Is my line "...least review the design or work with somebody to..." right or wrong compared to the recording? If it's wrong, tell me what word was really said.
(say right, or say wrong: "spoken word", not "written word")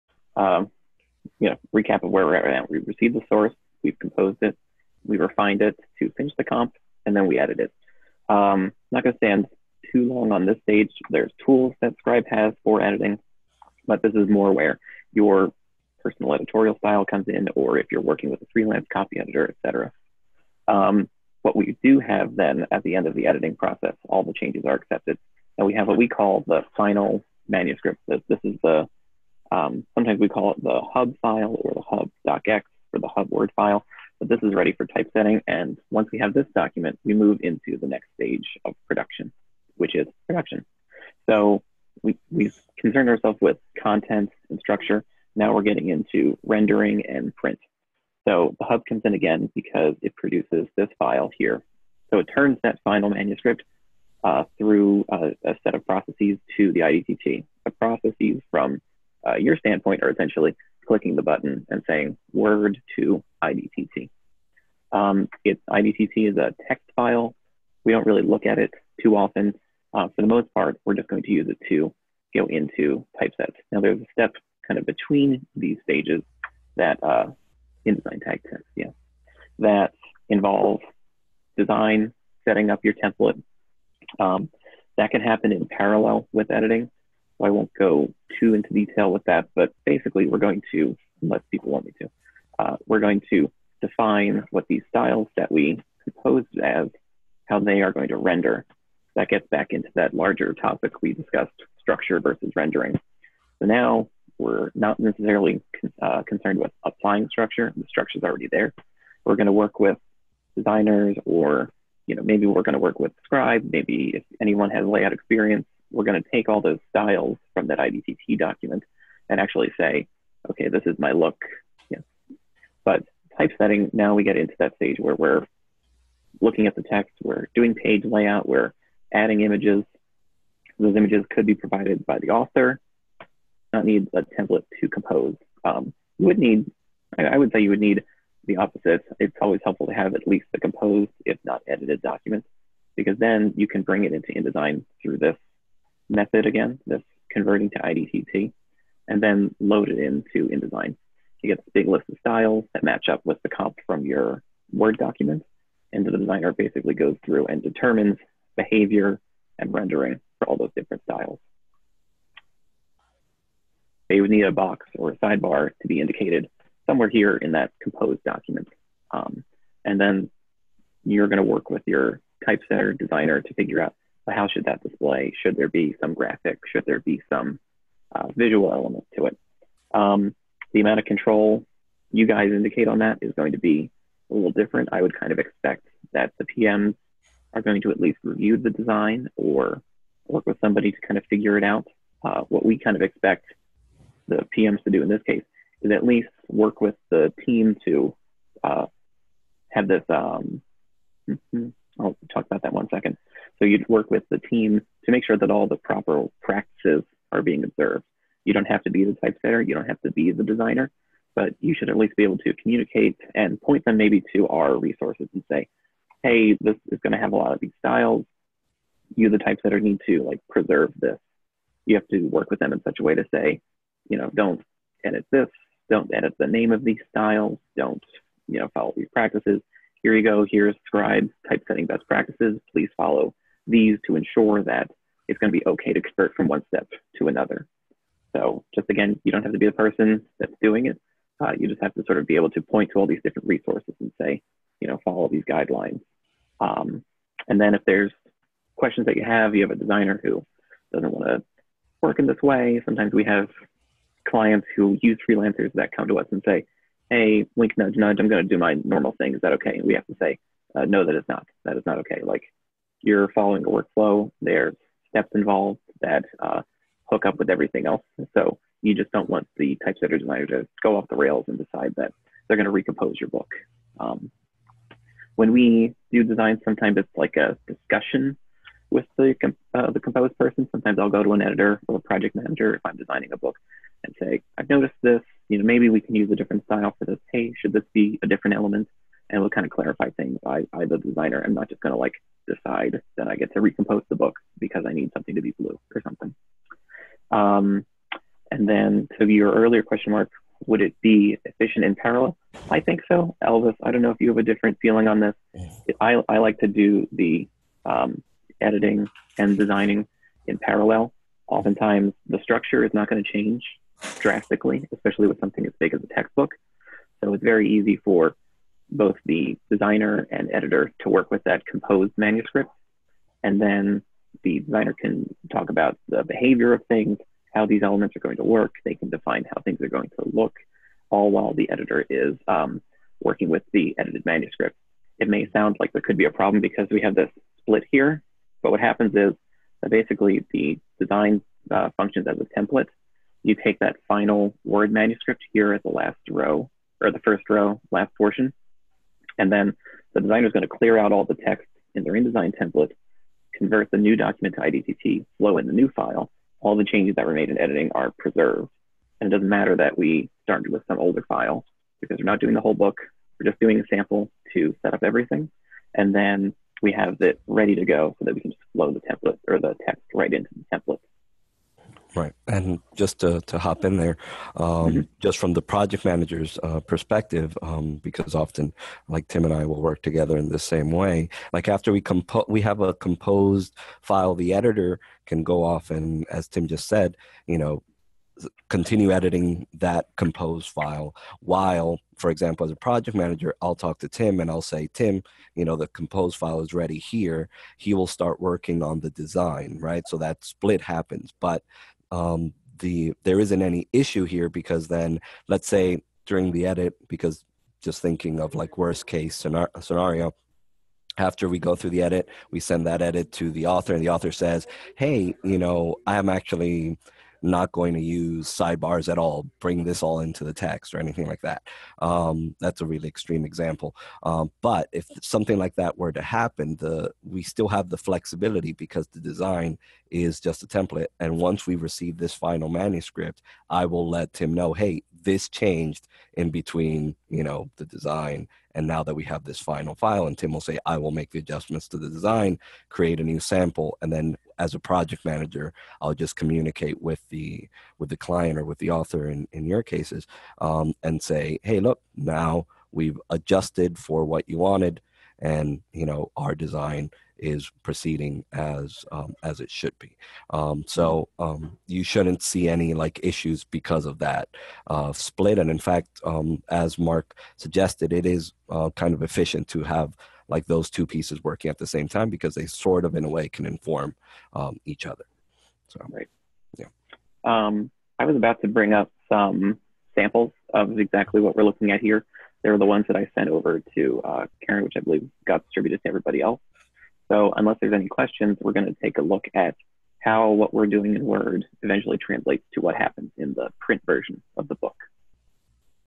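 right.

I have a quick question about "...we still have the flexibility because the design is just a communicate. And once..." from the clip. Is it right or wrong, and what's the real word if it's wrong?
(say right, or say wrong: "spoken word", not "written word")
wrong: "template", not "communicate".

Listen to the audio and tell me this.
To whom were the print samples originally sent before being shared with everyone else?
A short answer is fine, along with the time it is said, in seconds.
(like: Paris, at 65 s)
Karen, at 484 s.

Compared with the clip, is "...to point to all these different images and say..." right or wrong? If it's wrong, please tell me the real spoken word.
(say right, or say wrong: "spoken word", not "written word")
wrong: "resources", not "images".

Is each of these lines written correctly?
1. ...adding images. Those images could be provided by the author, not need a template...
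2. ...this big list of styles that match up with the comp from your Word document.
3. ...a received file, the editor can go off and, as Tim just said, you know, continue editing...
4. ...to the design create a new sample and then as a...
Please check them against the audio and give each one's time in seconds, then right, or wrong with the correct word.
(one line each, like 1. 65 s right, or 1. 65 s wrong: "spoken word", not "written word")
1. 129 s right
2. 151 s right
3. 382 s wrong: "composed", not "received"
4. 441 s right.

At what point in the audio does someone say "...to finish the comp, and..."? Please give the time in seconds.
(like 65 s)
5 s.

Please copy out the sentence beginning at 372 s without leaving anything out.
And just to, to hop in there, um, mm-hmm.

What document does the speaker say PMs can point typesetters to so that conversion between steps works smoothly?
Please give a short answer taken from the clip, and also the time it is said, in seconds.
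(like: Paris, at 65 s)
Scribe typesetting best practices, at 230 s.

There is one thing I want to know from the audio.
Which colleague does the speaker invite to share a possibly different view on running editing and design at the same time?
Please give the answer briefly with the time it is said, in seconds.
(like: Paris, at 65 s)
Elvis, at 303 s.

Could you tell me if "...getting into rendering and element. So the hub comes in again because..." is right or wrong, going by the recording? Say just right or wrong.
wrong.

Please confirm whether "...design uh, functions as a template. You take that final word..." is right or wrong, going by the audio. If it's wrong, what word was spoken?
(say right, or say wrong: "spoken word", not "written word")
right.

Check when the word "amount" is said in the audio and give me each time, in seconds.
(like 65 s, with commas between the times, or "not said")
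180 s.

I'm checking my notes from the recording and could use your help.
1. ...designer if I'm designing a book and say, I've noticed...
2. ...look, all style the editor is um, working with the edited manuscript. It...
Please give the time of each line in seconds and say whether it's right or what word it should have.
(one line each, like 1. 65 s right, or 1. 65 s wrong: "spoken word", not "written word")
1. 282 s wrong: "manager", not "designer"
2. 330 s wrong: "while", not "style".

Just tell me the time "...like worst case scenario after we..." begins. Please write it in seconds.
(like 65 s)
408 s.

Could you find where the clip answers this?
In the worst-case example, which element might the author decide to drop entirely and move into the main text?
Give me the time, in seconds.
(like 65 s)
418 s.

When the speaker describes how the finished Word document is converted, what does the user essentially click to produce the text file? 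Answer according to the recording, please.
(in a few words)
word to IDTT.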